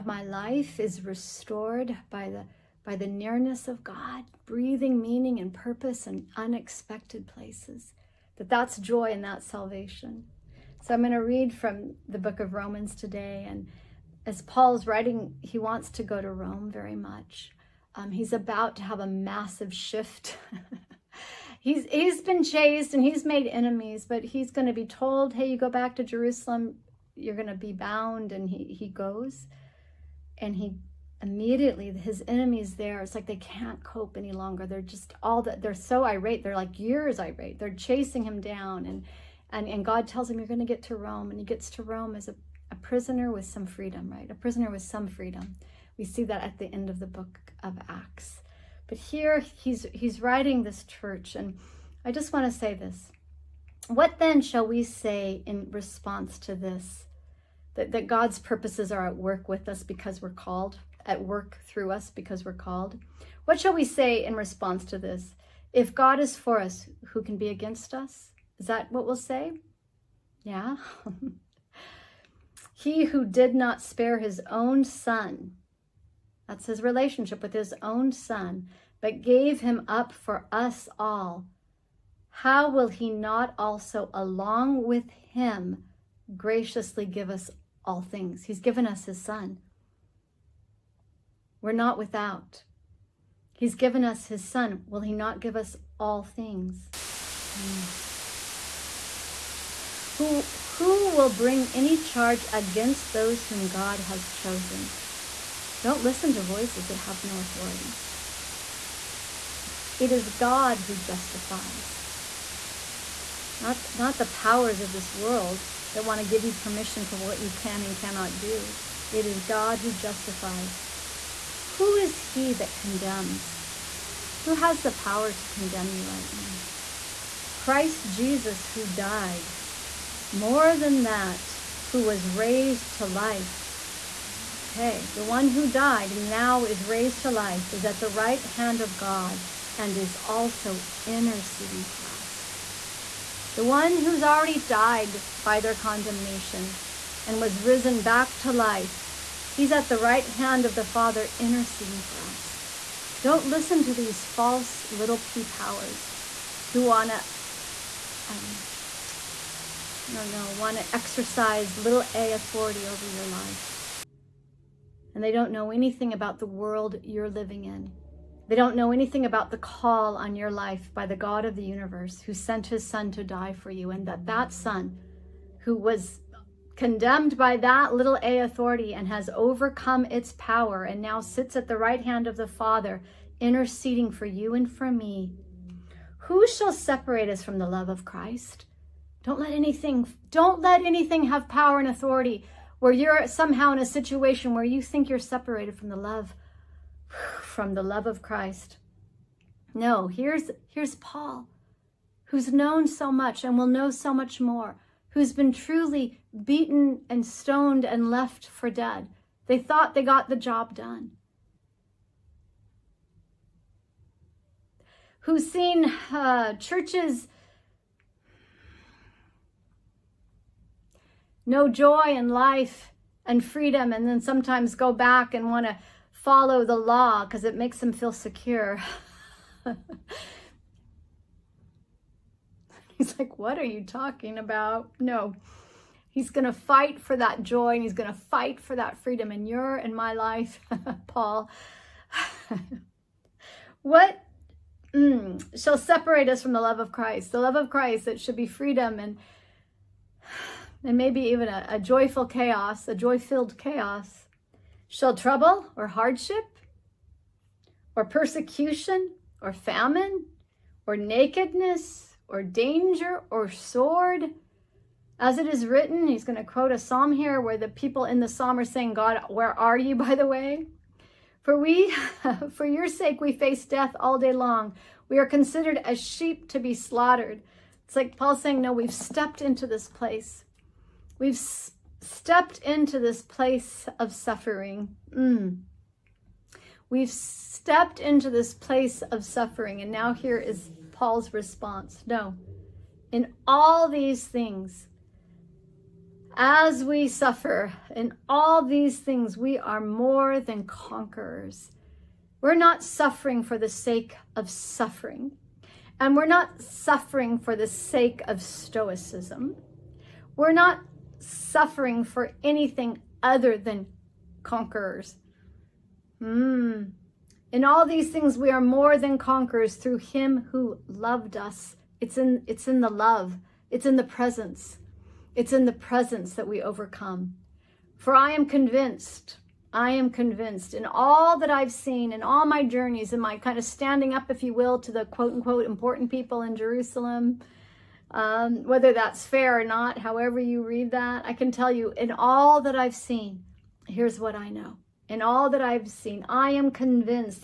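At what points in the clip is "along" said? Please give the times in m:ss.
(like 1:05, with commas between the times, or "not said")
1:24.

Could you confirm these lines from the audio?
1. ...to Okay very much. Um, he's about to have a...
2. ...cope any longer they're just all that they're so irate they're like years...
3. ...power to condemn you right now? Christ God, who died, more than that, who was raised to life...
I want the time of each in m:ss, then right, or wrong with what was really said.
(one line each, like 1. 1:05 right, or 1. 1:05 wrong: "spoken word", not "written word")
1. 0:16 wrong: "Rome", not "Okay"
2. 0:33 right
3. 2:04 wrong: "Jesus", not "God".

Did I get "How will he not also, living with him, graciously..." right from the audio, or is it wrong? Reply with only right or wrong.
wrong.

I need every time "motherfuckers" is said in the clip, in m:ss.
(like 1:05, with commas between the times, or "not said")
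not said.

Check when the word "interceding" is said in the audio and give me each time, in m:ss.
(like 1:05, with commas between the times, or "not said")
2:21, 2:31, 3:03.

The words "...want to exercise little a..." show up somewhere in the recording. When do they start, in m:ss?
2:40.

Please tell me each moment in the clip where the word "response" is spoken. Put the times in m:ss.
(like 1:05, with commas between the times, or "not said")
0:55, 1:04, 4:51.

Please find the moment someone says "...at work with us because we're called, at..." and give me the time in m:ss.
0:59.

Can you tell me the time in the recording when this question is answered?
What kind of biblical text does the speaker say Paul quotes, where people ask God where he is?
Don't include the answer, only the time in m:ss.
4:26.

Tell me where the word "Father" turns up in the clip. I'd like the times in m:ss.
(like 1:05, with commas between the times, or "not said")
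2:30, 3:02.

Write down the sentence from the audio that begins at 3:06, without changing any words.
Who shall separate us from the love of Christ?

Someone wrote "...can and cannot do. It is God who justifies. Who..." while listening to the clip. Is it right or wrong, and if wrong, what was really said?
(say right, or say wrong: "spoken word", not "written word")
right.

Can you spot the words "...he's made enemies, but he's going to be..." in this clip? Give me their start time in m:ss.
0:23.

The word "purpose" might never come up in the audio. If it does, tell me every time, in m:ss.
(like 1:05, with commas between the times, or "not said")
0:05, 0:58.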